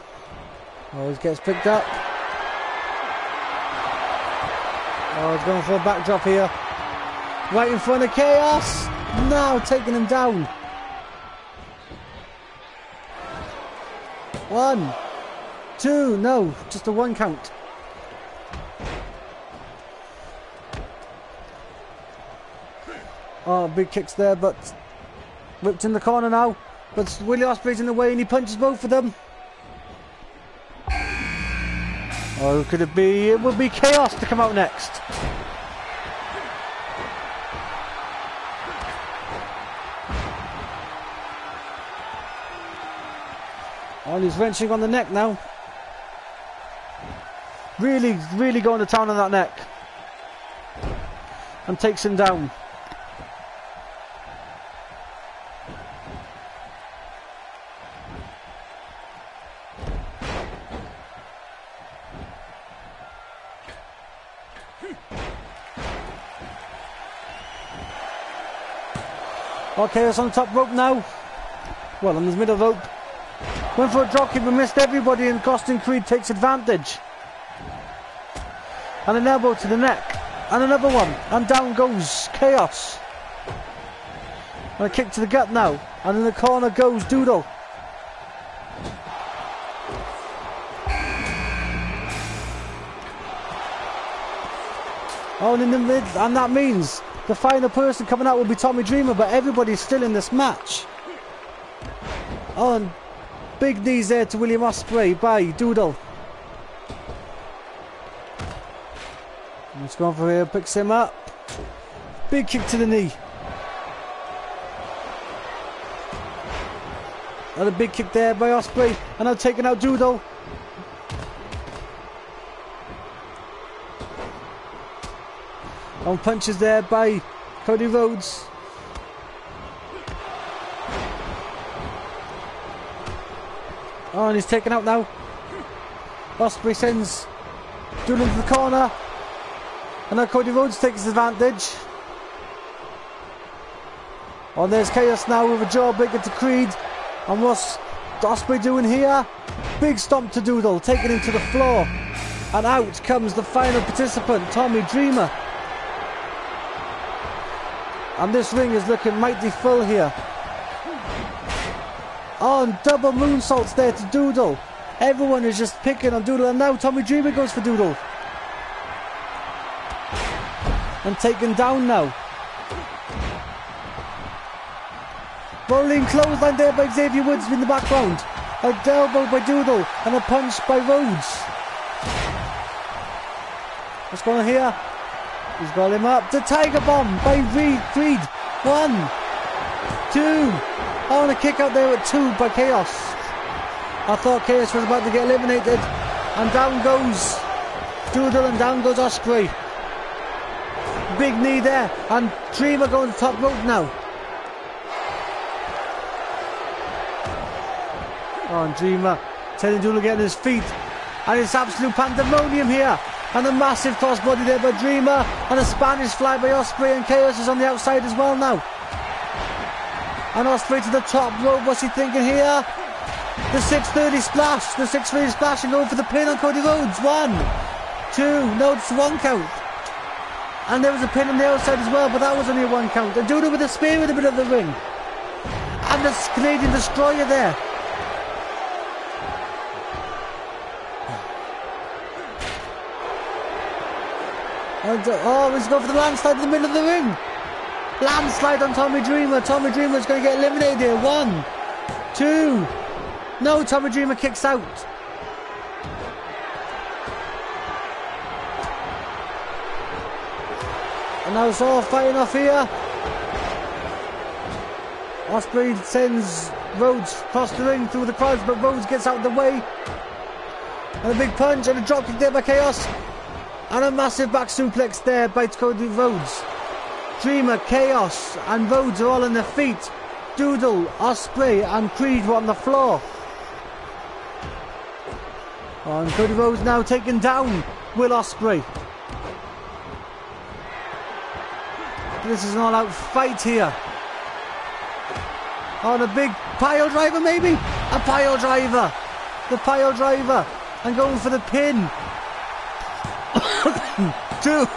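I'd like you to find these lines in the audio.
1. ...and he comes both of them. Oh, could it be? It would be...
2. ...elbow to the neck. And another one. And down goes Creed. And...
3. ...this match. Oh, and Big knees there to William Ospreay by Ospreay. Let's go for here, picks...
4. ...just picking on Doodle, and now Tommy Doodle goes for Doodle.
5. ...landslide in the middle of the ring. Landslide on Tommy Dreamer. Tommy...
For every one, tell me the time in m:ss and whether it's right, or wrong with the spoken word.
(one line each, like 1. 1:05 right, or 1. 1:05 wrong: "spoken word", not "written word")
1. 0:28 wrong: "punches", not "comes"
2. 1:19 wrong: "Chaos", not "Creed"
3. 1:40 wrong: "Doodle", not "Ospreay"
4. 2:45 wrong: "Dreamer", not "Doodle"
5. 4:05 right.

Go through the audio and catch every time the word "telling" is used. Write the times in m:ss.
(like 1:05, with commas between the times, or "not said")
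3:29.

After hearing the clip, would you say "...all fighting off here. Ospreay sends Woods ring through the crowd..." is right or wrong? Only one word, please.
wrong.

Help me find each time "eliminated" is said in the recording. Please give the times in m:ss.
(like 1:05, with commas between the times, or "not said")
3:15, 4:10.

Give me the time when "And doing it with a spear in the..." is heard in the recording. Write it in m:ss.
3:53.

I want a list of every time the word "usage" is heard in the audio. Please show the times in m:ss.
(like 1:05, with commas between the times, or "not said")
not said.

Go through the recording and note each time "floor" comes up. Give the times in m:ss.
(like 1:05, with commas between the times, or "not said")
2:31, 4:42.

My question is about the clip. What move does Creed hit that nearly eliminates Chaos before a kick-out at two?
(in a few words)
Tiger Bomb.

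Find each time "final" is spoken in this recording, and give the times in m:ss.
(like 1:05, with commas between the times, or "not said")
1:37, 2:33.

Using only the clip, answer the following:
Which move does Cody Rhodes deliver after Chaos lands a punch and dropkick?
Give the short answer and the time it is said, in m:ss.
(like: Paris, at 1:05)
back suplex, at 4:34.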